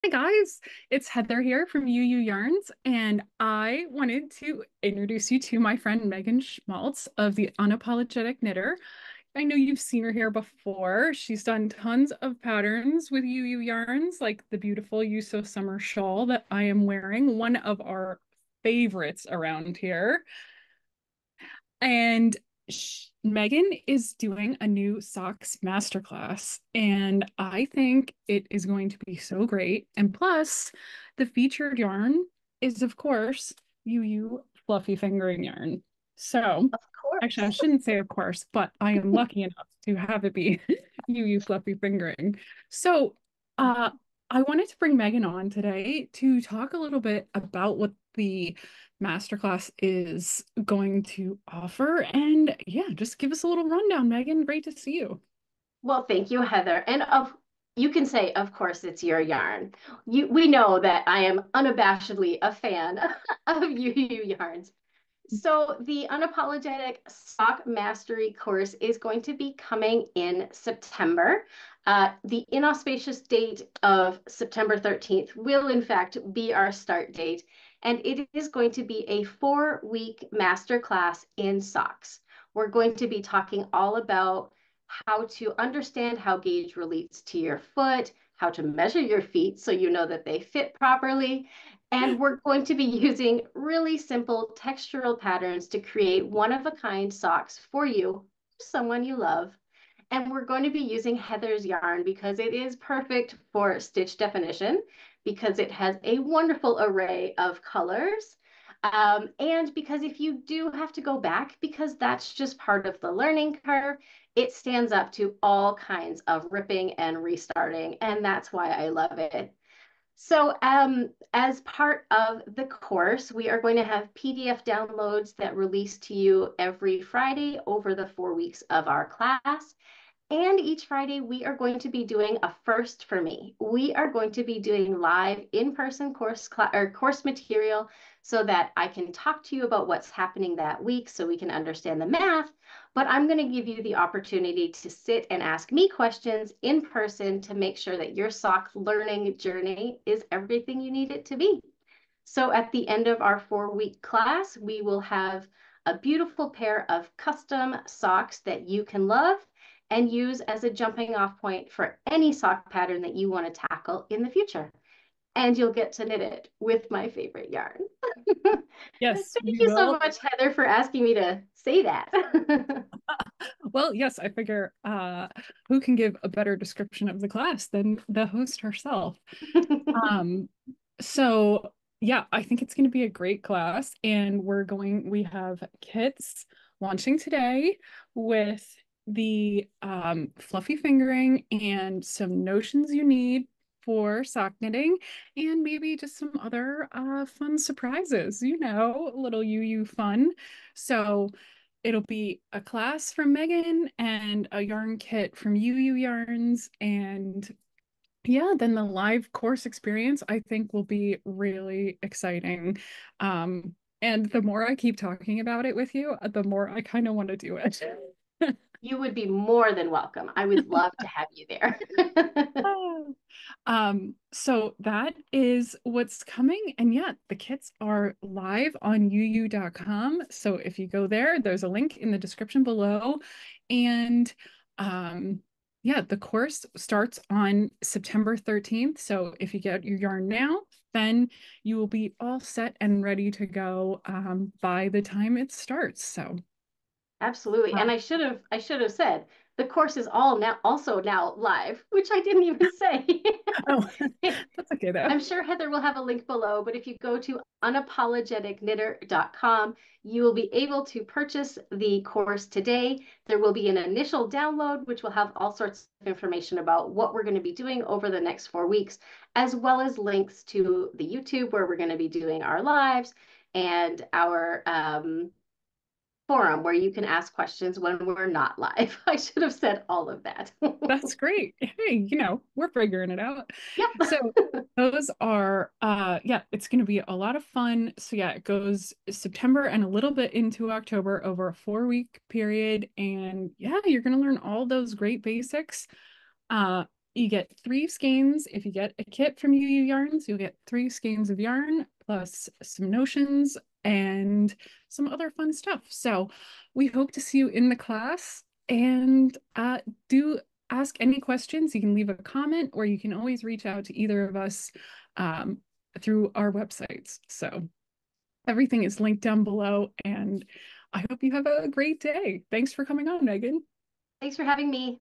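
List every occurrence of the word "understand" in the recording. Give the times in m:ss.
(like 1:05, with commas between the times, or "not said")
1:25, 2:21.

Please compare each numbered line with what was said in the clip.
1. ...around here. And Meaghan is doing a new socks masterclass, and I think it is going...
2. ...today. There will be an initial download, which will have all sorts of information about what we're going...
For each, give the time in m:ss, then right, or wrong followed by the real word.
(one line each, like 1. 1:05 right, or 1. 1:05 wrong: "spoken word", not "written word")
1. 0:19 right
2. 4:22 right.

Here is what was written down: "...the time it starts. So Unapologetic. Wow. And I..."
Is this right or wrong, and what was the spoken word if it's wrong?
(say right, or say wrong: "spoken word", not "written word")
wrong: "Absolutely", not "Unapologetic".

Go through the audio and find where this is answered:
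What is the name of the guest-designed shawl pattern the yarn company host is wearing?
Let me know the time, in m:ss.
0:15.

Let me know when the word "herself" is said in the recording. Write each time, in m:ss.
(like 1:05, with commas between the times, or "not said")
2:58.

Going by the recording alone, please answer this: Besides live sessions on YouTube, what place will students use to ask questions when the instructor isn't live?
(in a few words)
forum.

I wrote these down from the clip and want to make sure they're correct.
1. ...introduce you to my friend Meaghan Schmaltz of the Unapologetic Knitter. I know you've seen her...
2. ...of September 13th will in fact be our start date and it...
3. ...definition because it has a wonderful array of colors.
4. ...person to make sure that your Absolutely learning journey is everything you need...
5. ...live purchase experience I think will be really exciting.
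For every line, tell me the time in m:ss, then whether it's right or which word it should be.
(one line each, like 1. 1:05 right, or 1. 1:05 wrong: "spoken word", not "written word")
1. 0:04 right
2. 1:13 right
3. 1:44 right
4. 2:26 wrong: "SOC", not "Absolutely"
5. 3:28 wrong: "course", not "purchase".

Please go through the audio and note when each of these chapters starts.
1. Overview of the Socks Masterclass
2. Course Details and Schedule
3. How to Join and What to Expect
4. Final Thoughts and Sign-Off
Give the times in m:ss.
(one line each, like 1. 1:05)
1. 0:43
2. 2:00
3. 3:01
4. 5:05.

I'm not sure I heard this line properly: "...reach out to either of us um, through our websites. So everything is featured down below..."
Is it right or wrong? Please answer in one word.
wrong.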